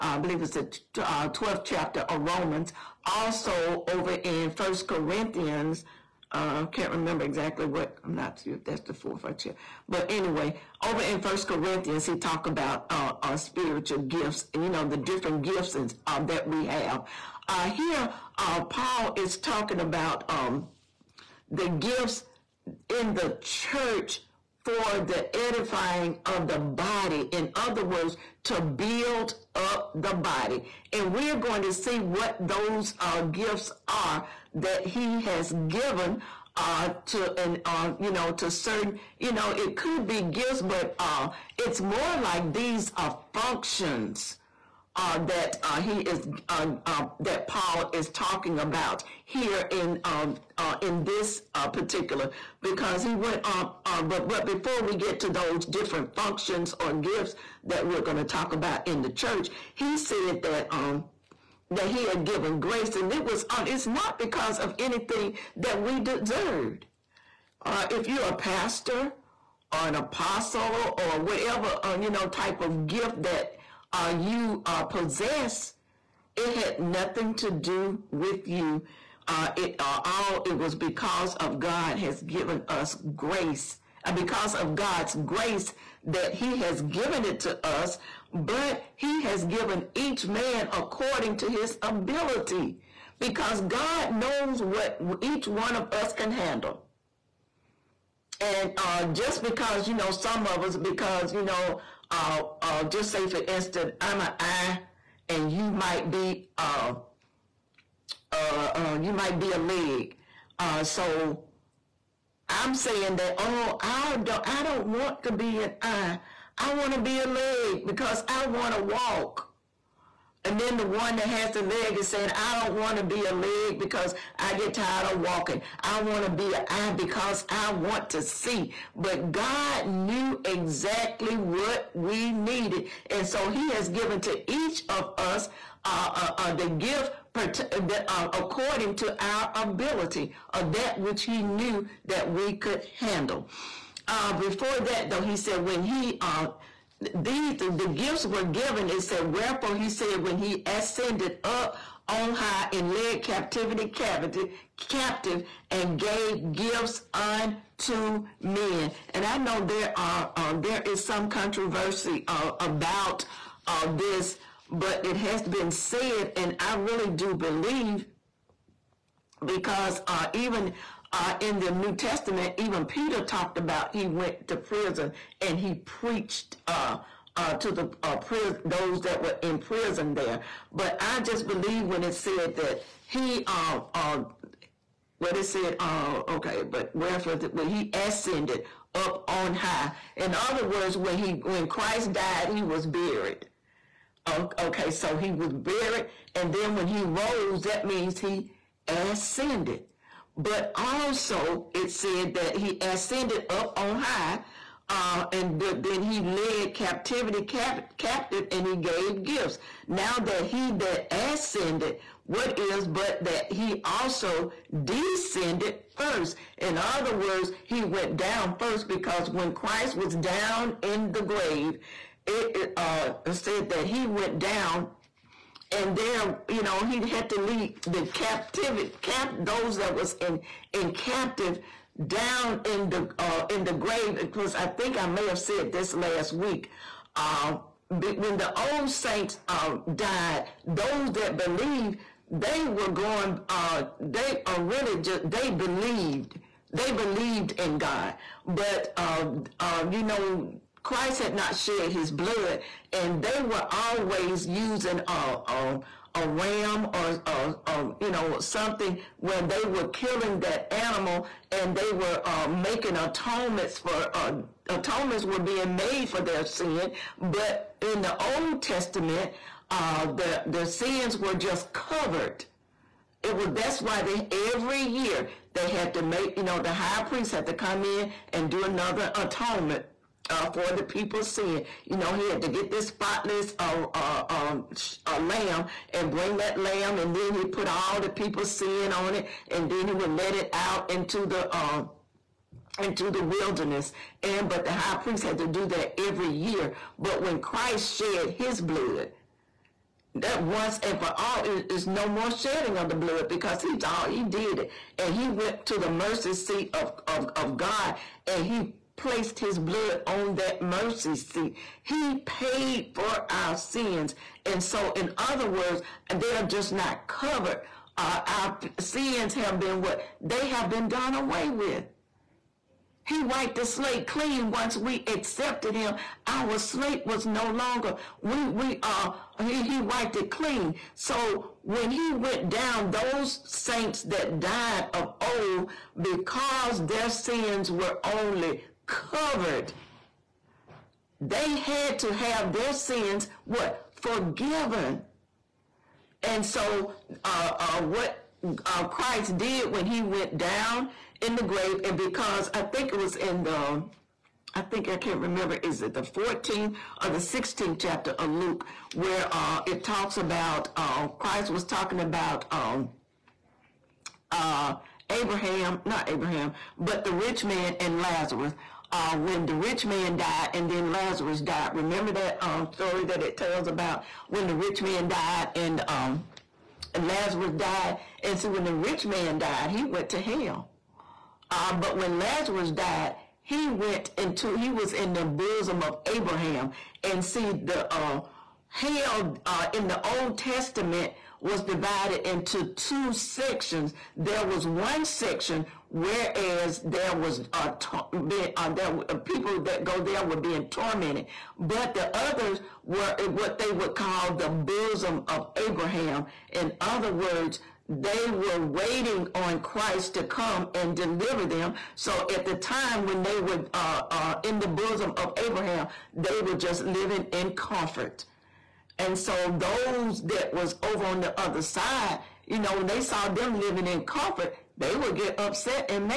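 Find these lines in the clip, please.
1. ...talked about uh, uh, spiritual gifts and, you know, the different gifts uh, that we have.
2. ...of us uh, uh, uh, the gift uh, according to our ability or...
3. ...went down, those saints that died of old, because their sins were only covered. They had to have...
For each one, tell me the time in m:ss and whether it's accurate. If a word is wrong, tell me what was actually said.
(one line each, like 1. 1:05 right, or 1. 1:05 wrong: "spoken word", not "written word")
1. 0:12 right
2. 2:14 right
3. 5:32 right.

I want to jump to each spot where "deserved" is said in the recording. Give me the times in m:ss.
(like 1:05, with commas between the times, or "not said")
1:05.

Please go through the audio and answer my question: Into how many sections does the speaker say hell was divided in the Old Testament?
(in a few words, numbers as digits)
2.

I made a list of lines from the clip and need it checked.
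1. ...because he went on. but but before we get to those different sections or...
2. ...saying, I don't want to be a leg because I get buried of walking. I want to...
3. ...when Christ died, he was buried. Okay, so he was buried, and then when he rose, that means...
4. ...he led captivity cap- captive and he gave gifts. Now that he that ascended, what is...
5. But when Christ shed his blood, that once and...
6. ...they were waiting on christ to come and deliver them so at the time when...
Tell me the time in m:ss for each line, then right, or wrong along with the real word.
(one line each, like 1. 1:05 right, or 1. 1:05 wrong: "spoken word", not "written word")
1. 0:52 wrong: "functions", not "sections"
2. 2:02 wrong: "tired", not "buried"
3. 3:11 right
4. 3:26 right
5. 4:56 right
6. 6:47 right.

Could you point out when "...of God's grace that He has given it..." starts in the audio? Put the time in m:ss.
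1:24.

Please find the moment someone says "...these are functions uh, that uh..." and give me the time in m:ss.
0:42.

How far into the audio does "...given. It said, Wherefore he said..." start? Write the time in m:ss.
2:28.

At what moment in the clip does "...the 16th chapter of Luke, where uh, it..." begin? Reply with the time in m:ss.
5:57.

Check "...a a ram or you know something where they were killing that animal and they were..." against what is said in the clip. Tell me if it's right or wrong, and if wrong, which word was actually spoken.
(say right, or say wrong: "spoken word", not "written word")
right.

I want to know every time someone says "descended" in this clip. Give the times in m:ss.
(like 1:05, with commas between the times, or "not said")
3:34.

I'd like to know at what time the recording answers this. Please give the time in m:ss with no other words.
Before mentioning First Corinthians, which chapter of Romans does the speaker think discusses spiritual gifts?
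0:01.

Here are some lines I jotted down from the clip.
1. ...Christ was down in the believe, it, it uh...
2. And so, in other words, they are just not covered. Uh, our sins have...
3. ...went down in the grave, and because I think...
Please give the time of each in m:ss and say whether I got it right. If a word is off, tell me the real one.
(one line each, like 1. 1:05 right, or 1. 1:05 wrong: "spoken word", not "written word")
1. 3:39 wrong: "grave", not "believe"
2. 5:14 right
3. 5:50 right.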